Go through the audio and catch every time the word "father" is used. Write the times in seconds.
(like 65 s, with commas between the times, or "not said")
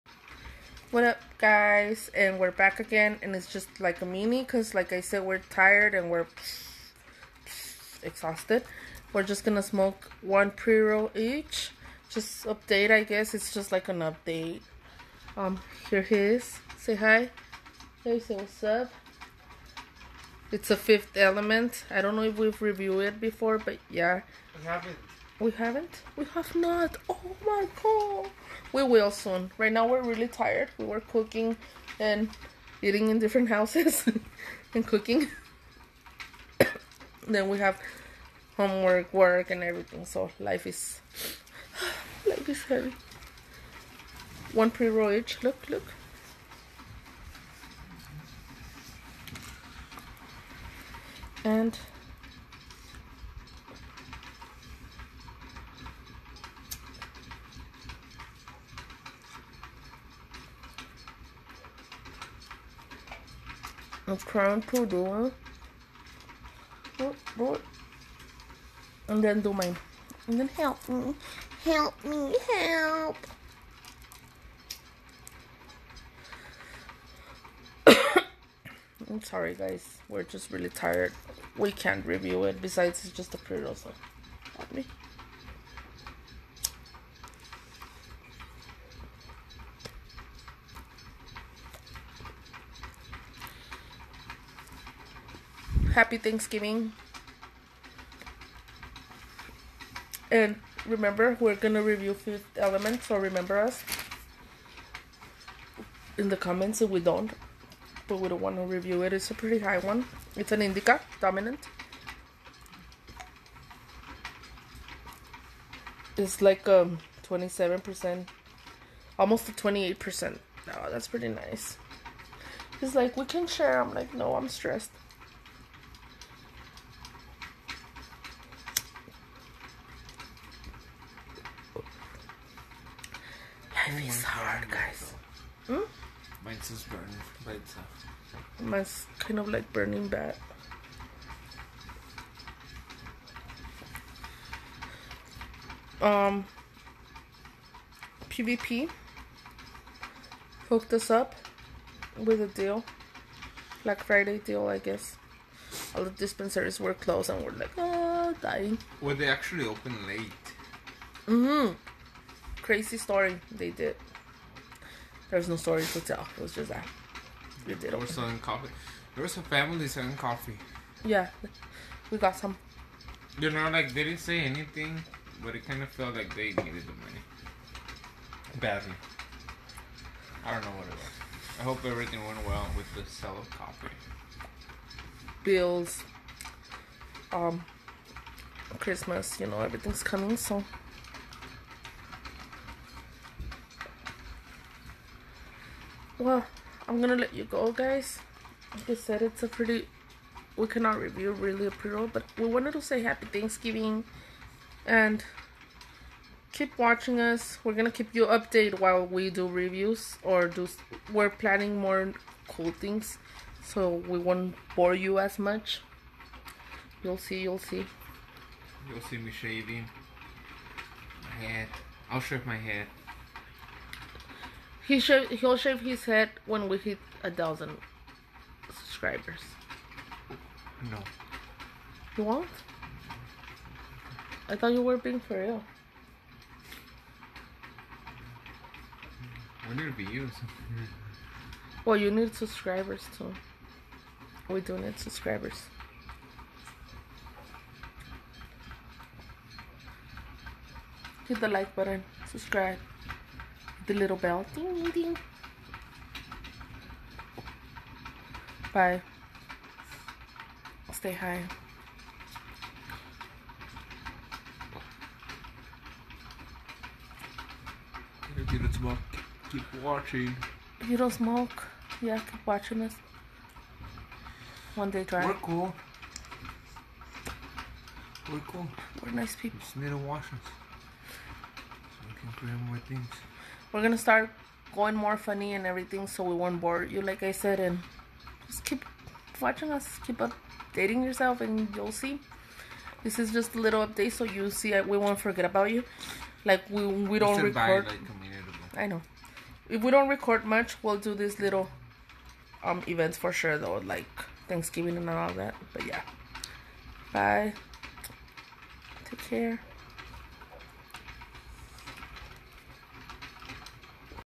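not said.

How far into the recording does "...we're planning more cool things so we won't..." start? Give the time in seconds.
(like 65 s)
211 s.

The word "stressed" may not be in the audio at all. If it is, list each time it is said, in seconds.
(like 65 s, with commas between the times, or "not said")
124 s.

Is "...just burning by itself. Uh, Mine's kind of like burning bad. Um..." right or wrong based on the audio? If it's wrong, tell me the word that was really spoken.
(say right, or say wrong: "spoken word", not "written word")
right.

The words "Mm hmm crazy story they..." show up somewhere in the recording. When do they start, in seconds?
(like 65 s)
161 s.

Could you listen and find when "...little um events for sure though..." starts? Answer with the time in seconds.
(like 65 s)
301 s.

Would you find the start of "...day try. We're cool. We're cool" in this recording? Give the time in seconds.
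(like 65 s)
274 s.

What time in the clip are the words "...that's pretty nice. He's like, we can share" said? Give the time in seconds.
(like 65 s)
120 s.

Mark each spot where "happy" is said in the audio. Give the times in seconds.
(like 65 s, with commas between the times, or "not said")
95 s, 203 s.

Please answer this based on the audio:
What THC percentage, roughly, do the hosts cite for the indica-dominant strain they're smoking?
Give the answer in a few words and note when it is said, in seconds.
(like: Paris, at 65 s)
27%, at 117 s.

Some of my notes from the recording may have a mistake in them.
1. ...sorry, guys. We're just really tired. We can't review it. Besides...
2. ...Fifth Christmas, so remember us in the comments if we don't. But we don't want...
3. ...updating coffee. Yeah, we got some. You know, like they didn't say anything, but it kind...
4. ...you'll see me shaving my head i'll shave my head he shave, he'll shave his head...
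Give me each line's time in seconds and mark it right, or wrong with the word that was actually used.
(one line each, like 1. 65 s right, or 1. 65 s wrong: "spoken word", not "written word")
1. 79 s right
2. 102 s wrong: "Element", not "Christmas"
3. 169 s wrong: "selling", not "updating"
4. 218 s right.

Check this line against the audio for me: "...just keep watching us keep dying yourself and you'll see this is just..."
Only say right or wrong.
wrong.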